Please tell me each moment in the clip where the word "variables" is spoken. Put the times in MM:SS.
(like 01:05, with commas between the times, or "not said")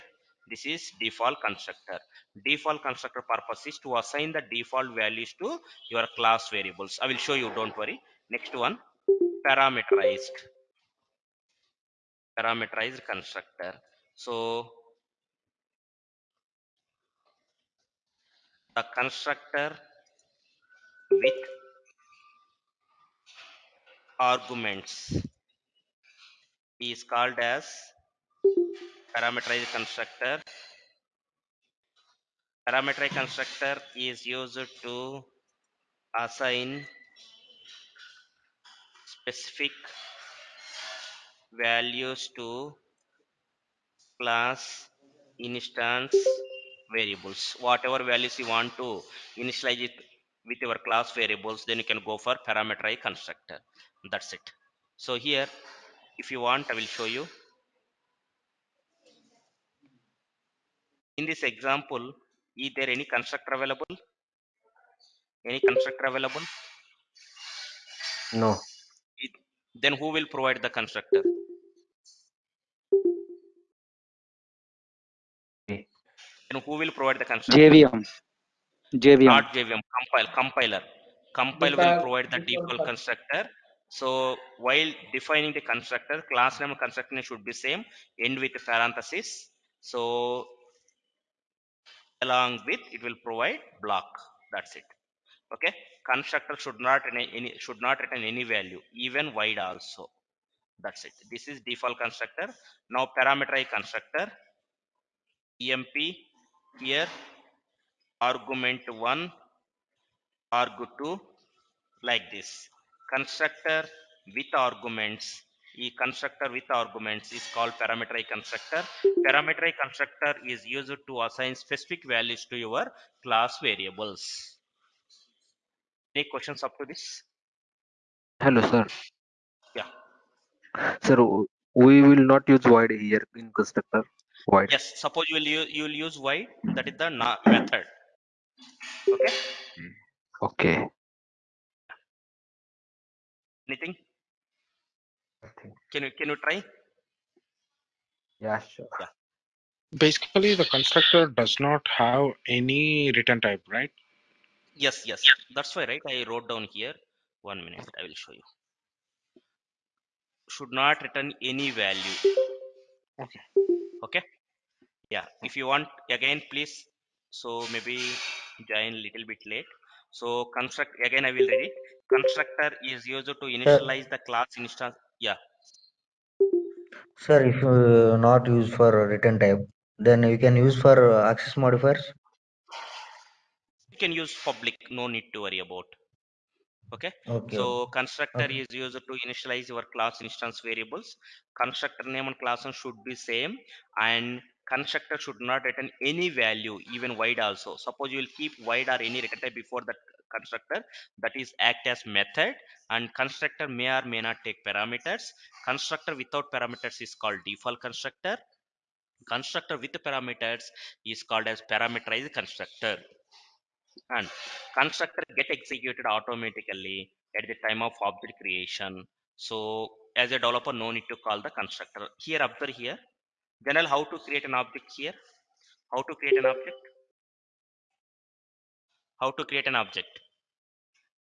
00:06, 00:46, 00:51, 02:03, 03:10.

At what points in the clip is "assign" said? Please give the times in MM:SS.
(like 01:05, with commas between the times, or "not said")
00:03, 00:36, 02:01.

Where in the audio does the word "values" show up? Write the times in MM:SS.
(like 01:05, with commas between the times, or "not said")
00:04, 00:41, 00:48, 01:38, 02:02, 02:41, 03:16.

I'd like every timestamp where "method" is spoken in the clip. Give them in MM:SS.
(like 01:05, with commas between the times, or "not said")
02:17, 03:22.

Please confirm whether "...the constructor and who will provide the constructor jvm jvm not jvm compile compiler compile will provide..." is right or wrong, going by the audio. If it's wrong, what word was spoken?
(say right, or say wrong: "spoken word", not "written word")
right.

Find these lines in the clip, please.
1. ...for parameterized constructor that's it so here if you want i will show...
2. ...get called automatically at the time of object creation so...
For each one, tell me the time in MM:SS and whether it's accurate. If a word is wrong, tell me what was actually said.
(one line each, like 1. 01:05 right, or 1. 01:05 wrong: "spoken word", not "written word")
1. 00:52 right
2. 03:35 wrong: "executed", not "called".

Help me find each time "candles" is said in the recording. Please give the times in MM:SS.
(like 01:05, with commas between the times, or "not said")
not said.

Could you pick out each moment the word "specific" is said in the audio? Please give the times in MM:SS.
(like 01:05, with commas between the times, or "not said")
00:39, 02:01.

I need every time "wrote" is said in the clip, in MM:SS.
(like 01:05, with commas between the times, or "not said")
02:36.